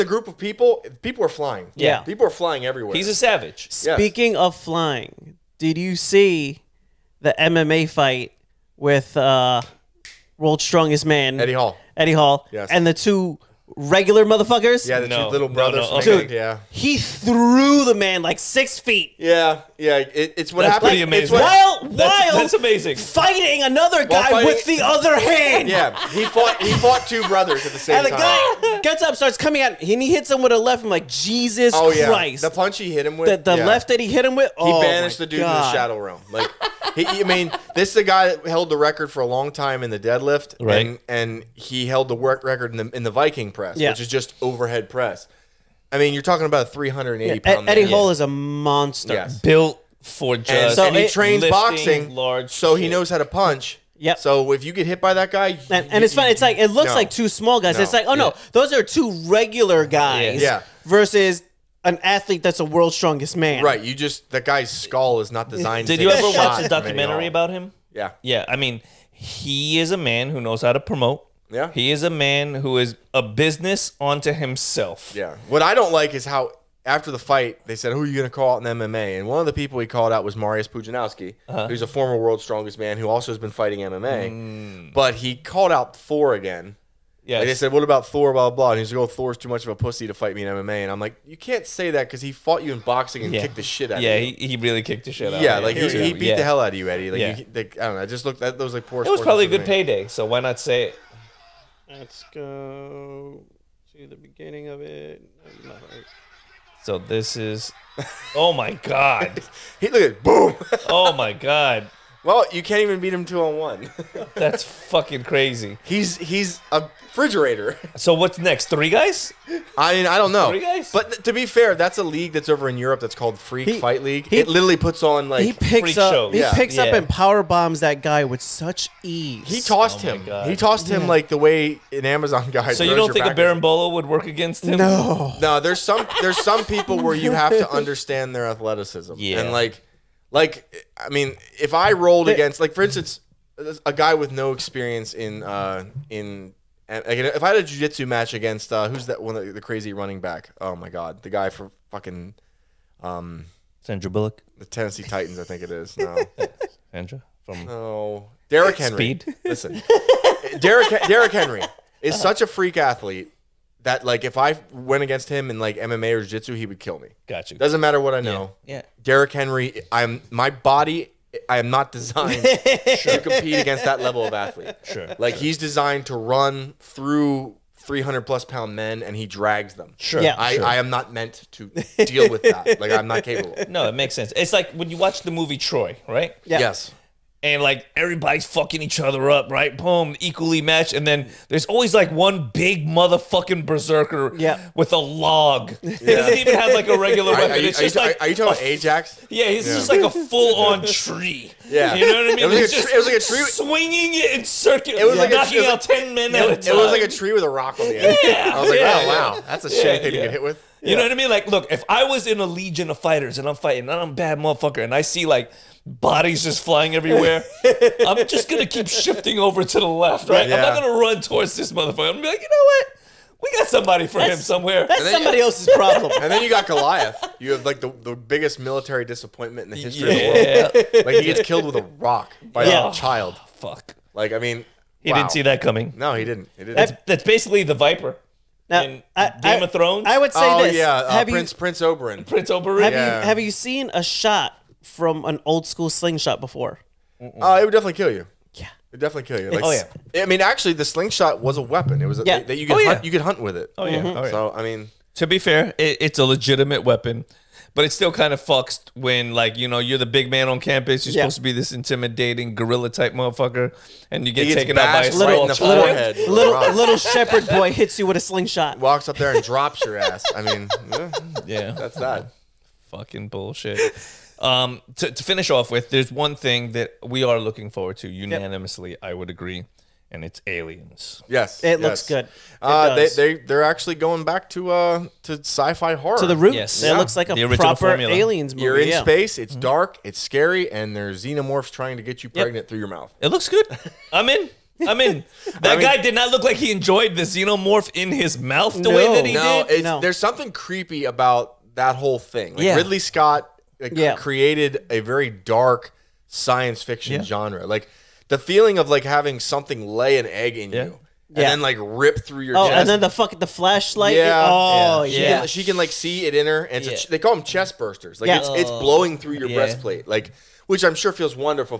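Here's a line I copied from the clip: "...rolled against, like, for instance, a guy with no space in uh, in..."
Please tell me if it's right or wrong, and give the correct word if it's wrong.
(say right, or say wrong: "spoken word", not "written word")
wrong: "experience", not "space".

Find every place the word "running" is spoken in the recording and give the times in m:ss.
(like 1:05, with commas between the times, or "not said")
2:29.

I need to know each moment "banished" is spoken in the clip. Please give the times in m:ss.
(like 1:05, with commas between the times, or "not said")
0:34.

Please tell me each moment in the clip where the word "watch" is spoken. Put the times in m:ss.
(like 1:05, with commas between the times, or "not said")
1:06, 3:04.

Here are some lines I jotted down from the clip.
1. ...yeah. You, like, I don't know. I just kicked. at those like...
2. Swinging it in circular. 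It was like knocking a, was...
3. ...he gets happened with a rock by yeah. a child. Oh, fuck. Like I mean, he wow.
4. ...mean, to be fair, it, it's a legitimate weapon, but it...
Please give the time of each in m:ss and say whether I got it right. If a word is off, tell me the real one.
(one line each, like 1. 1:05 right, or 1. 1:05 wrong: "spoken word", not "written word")
1. 1:37 wrong: "looked", not "kicked"
2. 3:23 right
3. 3:51 wrong: "killed", not "happened"
4. 4:14 right.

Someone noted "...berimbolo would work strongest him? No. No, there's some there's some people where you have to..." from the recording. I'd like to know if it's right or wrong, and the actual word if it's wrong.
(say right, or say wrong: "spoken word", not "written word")
wrong: "against", not "strongest".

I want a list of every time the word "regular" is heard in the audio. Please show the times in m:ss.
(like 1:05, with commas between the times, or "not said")
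0:13, 0:59, 3:16.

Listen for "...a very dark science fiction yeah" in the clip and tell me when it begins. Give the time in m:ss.
5:04.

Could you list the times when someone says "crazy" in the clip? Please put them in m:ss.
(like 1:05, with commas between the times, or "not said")
1:55, 2:29.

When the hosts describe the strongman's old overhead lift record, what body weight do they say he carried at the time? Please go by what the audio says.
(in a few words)
380 pounds.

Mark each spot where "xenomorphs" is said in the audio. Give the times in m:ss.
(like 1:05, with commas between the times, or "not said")
4:51, 4:57.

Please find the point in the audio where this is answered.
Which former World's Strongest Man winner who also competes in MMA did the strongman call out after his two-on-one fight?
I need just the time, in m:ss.
1:20.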